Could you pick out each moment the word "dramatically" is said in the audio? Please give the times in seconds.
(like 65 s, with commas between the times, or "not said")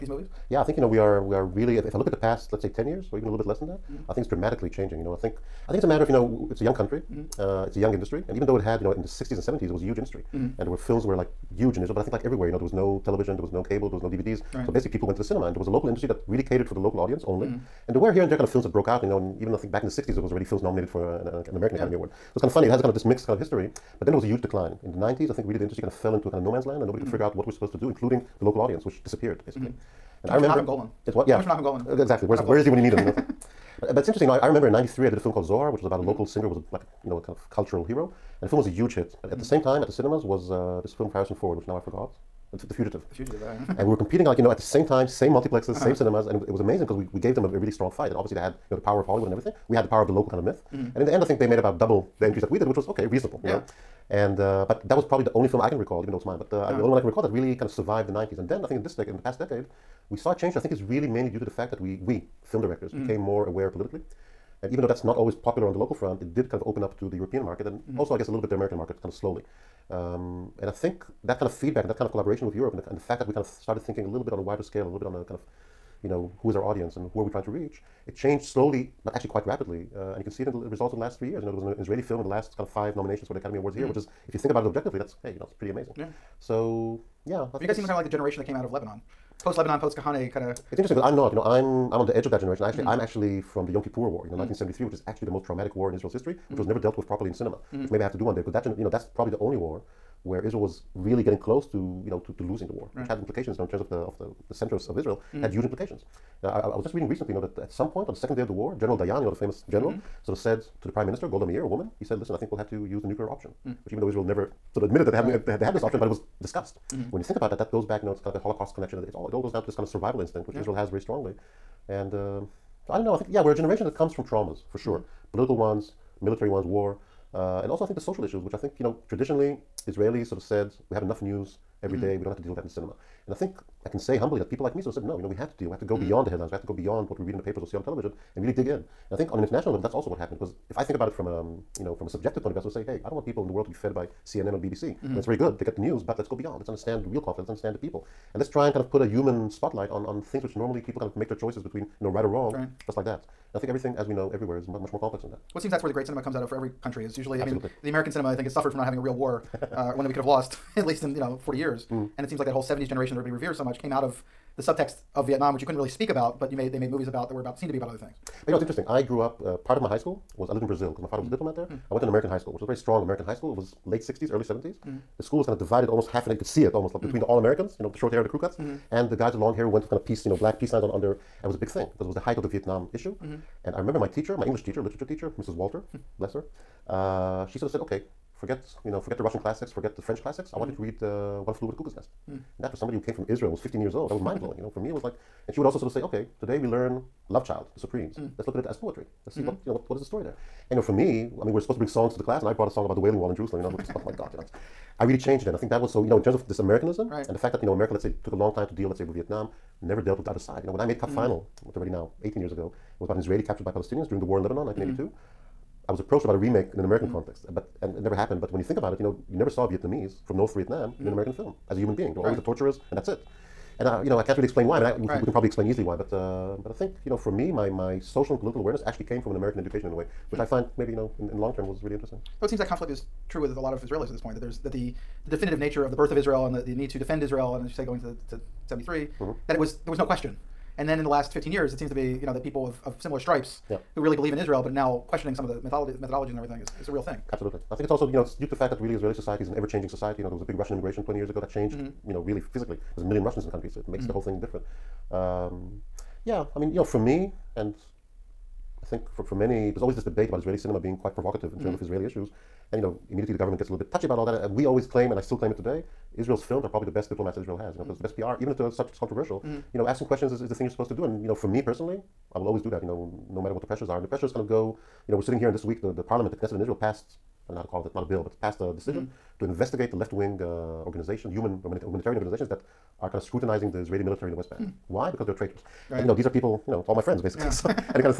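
4 s.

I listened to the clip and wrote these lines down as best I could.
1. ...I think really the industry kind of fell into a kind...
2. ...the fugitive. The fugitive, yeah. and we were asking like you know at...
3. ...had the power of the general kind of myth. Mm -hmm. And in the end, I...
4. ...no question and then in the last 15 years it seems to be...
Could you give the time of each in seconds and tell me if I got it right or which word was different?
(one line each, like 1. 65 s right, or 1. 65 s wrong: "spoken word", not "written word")
1. 25 s right
2. 42 s wrong: "competing", not "asking"
3. 49 s wrong: "local", not "general"
4. 239 s right.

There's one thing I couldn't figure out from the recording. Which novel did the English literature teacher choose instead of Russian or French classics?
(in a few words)
One Flew Over the Cuckoo's Nest.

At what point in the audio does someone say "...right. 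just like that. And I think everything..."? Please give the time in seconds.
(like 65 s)
152 s.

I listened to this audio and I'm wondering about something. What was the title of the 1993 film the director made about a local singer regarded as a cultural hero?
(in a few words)
Zohar.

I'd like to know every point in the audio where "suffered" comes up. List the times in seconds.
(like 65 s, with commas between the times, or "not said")
158 s.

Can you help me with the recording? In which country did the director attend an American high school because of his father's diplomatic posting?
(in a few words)
Brazil.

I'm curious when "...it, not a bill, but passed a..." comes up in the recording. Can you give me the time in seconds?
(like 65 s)
277 s.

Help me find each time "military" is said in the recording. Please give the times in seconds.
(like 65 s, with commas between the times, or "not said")
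126 s, 284 s.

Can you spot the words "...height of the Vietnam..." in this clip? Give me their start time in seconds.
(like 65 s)
182 s.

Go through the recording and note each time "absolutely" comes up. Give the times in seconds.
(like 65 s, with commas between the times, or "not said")
247 s.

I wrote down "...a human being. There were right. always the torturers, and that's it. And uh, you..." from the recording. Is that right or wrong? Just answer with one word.
right.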